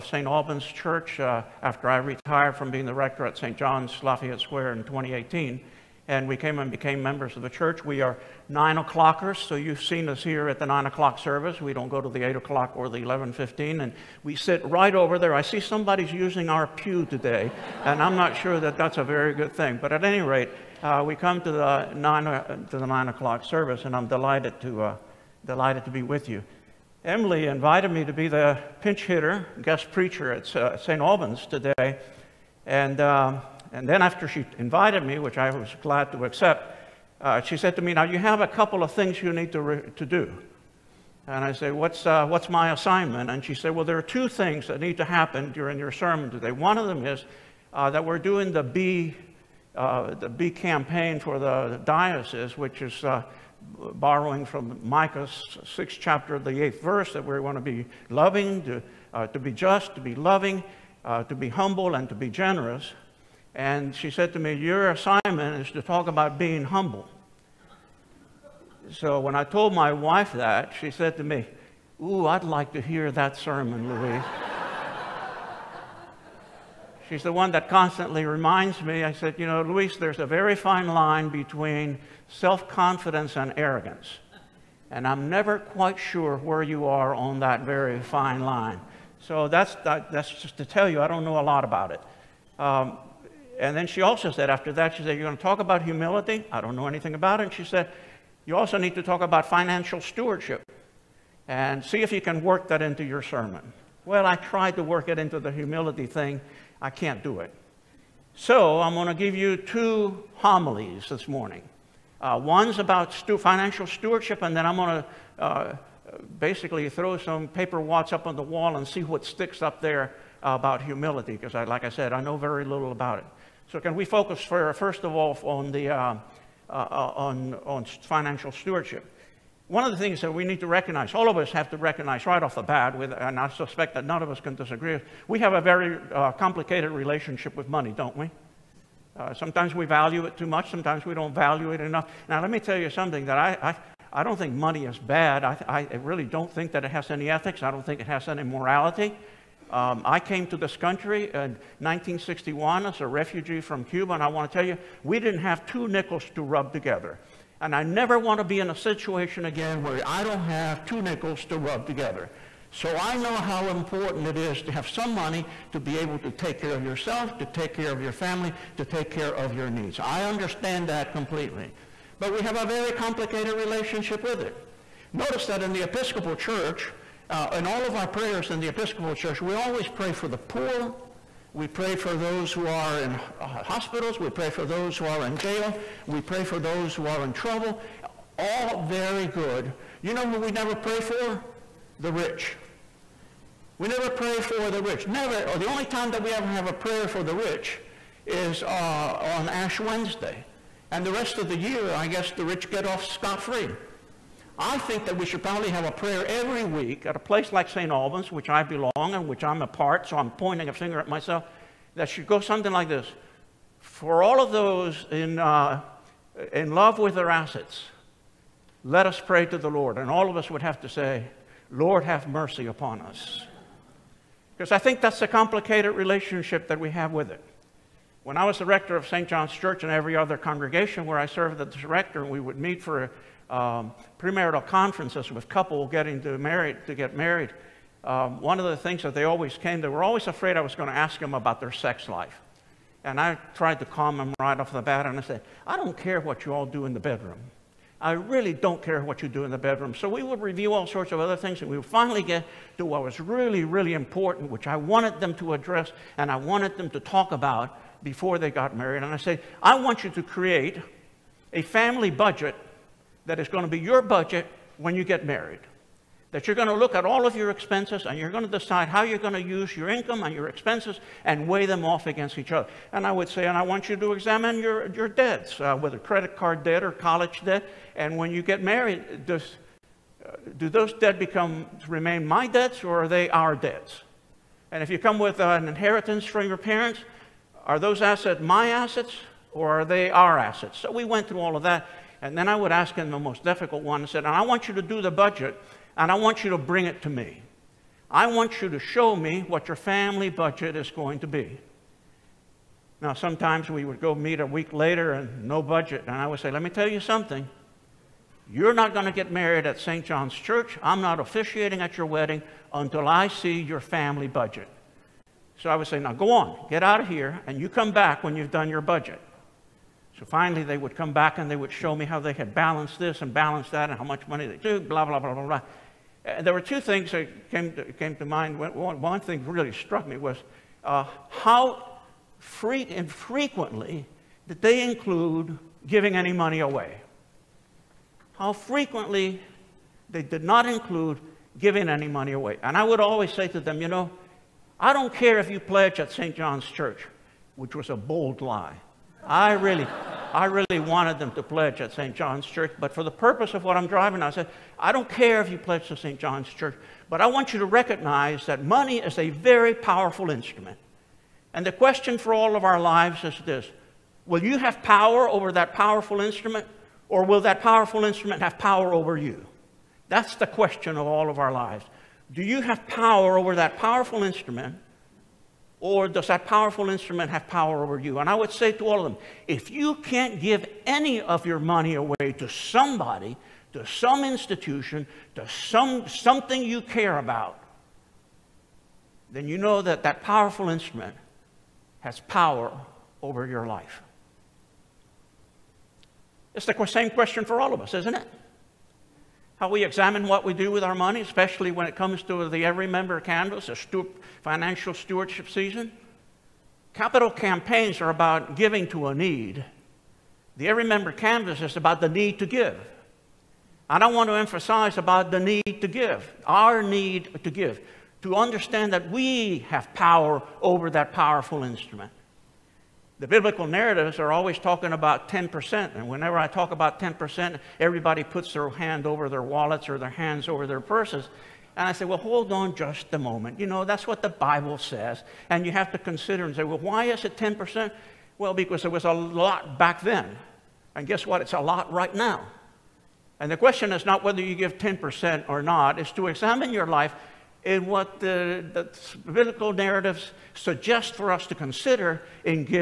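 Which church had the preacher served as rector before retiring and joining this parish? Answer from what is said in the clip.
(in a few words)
St. John's Lafayette Square.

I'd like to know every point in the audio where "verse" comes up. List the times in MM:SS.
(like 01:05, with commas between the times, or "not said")
00:56.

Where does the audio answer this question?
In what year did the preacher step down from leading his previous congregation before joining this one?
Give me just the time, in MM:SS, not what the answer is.
00:04.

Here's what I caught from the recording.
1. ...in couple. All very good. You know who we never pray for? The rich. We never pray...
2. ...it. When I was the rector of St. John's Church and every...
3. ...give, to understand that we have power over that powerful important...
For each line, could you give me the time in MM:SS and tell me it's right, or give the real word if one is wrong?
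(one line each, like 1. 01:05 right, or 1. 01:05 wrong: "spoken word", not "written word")
1. 03:07 wrong: "trouble", not "couple"
2. 03:47 right
3. 06:57 wrong: "instrument", not "important".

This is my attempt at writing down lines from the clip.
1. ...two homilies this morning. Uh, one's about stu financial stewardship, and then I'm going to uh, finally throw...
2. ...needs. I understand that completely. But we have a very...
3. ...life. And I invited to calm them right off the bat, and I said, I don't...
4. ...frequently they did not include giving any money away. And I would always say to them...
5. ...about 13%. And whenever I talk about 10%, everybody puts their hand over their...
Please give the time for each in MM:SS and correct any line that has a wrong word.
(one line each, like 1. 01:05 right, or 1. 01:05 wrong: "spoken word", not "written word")
1. 01:49 wrong: "basically", not "finally"
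2. 02:49 right
3. 04:02 wrong: "tried", not "invited"
4. 05:38 right
5. 07:04 wrong: "10", not "13".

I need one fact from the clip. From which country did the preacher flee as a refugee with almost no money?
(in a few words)
Cuba.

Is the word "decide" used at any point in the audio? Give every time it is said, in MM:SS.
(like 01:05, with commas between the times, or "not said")
04:28.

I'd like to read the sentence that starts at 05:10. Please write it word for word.
I'm not officiating at your wedding until I see your family budget.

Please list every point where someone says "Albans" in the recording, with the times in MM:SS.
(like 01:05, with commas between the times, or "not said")
00:00, 00:31, 03:27.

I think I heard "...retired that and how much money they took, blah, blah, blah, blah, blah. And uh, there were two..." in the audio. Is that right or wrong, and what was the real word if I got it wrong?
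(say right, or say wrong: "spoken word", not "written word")
wrong: "balanced", not "retired".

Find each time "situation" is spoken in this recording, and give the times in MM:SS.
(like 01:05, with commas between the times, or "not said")
02:38.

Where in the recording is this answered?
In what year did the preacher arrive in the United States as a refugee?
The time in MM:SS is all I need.
02:31.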